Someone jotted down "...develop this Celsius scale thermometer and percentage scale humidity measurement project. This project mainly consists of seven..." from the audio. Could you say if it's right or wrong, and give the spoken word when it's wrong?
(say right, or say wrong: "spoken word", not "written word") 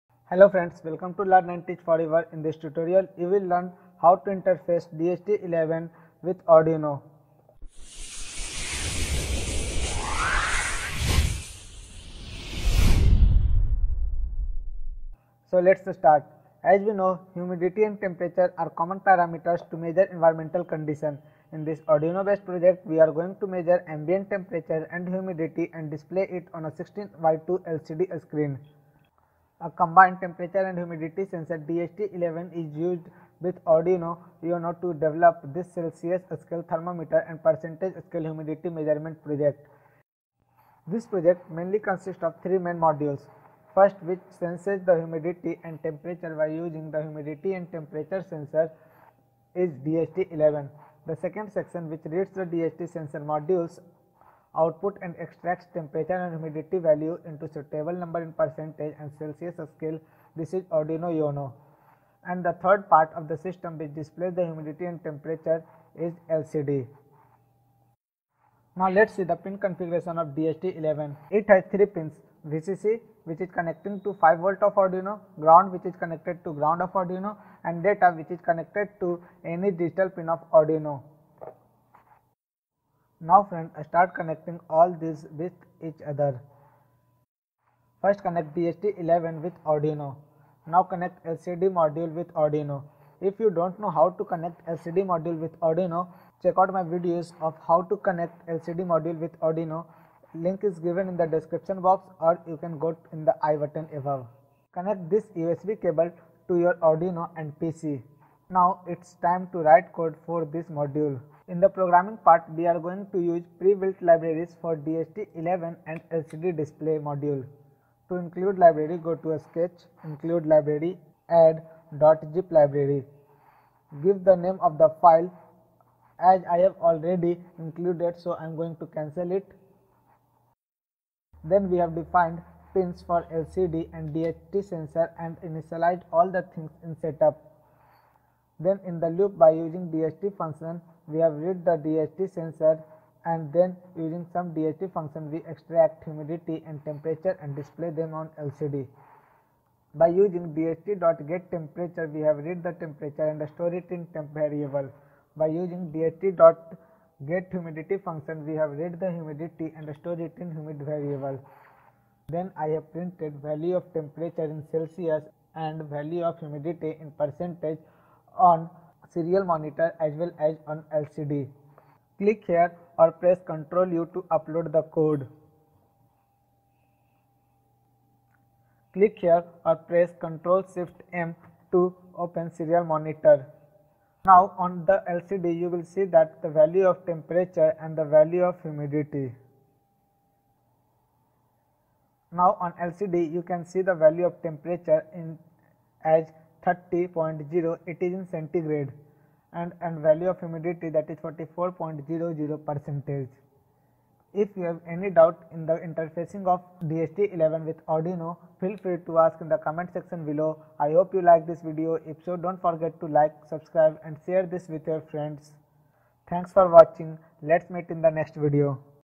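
wrong: "three", not "seven".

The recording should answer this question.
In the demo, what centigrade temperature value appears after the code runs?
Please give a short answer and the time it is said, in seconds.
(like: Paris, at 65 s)
30.0, at 196 s.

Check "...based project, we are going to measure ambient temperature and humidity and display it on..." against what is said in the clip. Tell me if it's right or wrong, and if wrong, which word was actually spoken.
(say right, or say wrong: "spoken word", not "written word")
right.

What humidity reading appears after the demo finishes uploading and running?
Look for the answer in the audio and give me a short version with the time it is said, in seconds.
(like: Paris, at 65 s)
44.00%, at 201 s.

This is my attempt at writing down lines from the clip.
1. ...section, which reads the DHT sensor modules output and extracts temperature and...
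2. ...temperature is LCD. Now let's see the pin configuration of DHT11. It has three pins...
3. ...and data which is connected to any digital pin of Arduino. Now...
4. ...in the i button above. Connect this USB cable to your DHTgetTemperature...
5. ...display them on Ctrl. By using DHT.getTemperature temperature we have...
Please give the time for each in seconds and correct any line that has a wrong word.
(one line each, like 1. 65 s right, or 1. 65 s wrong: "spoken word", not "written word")
1. 51 s right
2. 65 s right
3. 77 s right
4. 103 s wrong: "Arduino", not "DHTgetTemperature"
5. 147 s wrong: "LCD", not "Ctrl".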